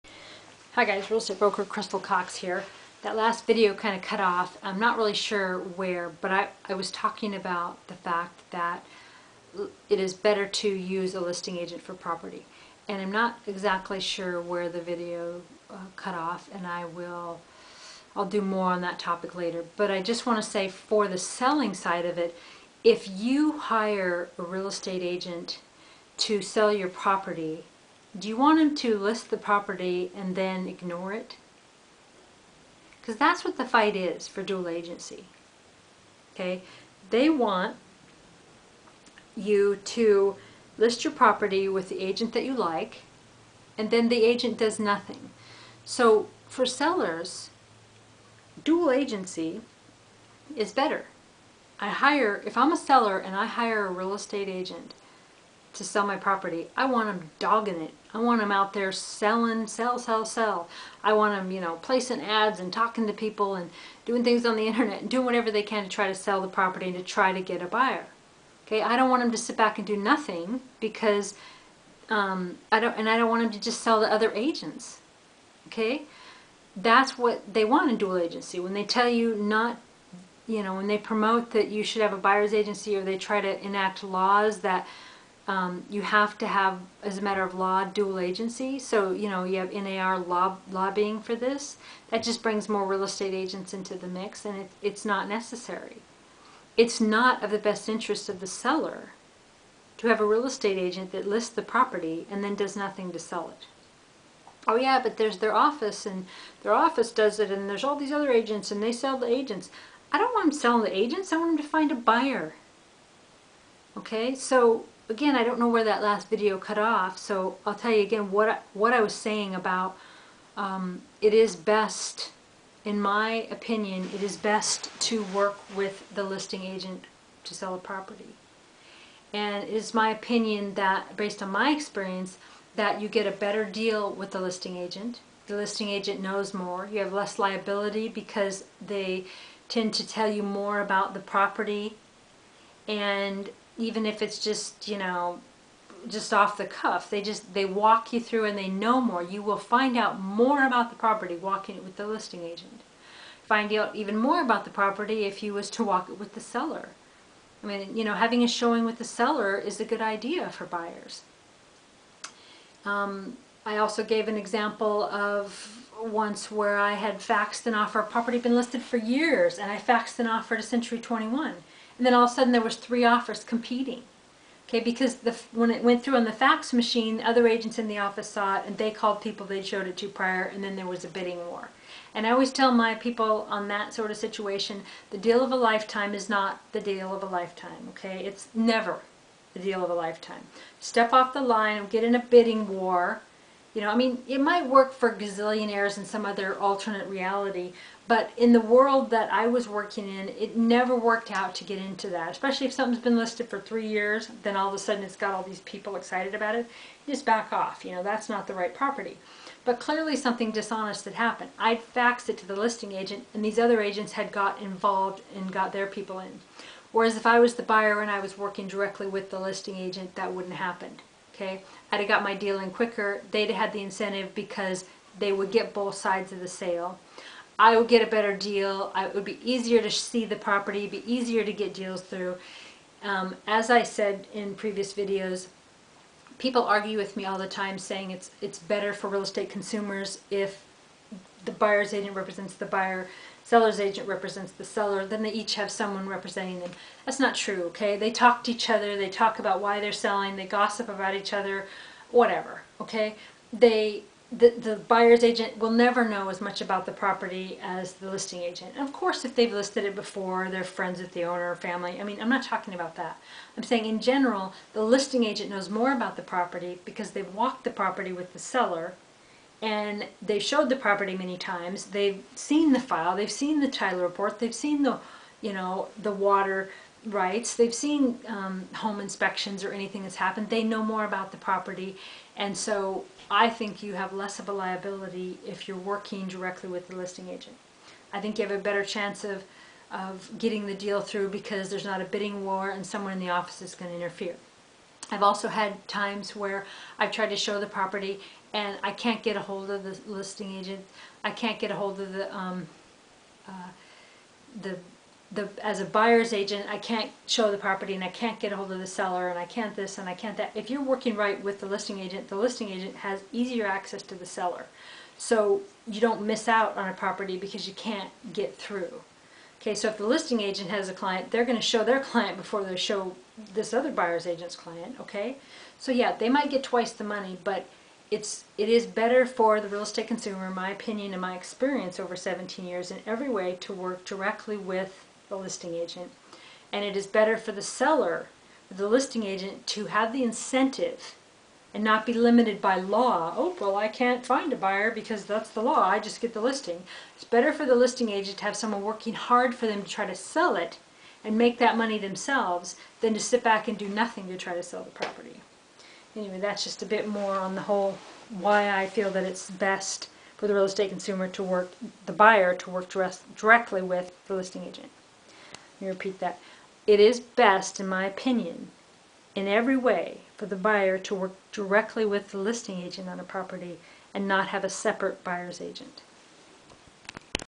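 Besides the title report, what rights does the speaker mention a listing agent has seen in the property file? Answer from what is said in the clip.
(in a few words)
water rights.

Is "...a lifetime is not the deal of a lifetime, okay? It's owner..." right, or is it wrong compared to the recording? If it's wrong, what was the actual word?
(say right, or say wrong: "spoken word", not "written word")
wrong: "never", not "owner".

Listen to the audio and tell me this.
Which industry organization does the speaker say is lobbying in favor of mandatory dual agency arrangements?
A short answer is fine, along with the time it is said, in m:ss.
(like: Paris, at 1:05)
NAR, at 1:29.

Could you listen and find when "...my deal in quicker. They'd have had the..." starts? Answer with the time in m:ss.
3:42.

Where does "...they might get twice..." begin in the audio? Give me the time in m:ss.
5:26.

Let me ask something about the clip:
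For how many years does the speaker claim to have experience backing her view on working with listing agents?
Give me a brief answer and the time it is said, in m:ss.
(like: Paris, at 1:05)
17, at 5:32.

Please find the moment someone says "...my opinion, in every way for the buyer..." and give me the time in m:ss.
6:07.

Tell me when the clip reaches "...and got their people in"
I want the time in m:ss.
3:35.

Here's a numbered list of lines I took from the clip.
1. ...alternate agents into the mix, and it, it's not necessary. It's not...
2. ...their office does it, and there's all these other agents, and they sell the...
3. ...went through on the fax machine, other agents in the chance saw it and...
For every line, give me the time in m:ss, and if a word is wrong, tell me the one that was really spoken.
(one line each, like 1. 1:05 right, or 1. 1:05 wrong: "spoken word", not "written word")
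1. 1:33 wrong: "estate", not "alternate"
2. 1:46 right
3. 2:55 wrong: "office", not "chance".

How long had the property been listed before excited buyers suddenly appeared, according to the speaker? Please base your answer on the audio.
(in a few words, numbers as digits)
3 years.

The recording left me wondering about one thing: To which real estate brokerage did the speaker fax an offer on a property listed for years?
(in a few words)
Century 21.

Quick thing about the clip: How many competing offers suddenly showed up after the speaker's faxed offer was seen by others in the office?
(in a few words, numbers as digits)
3.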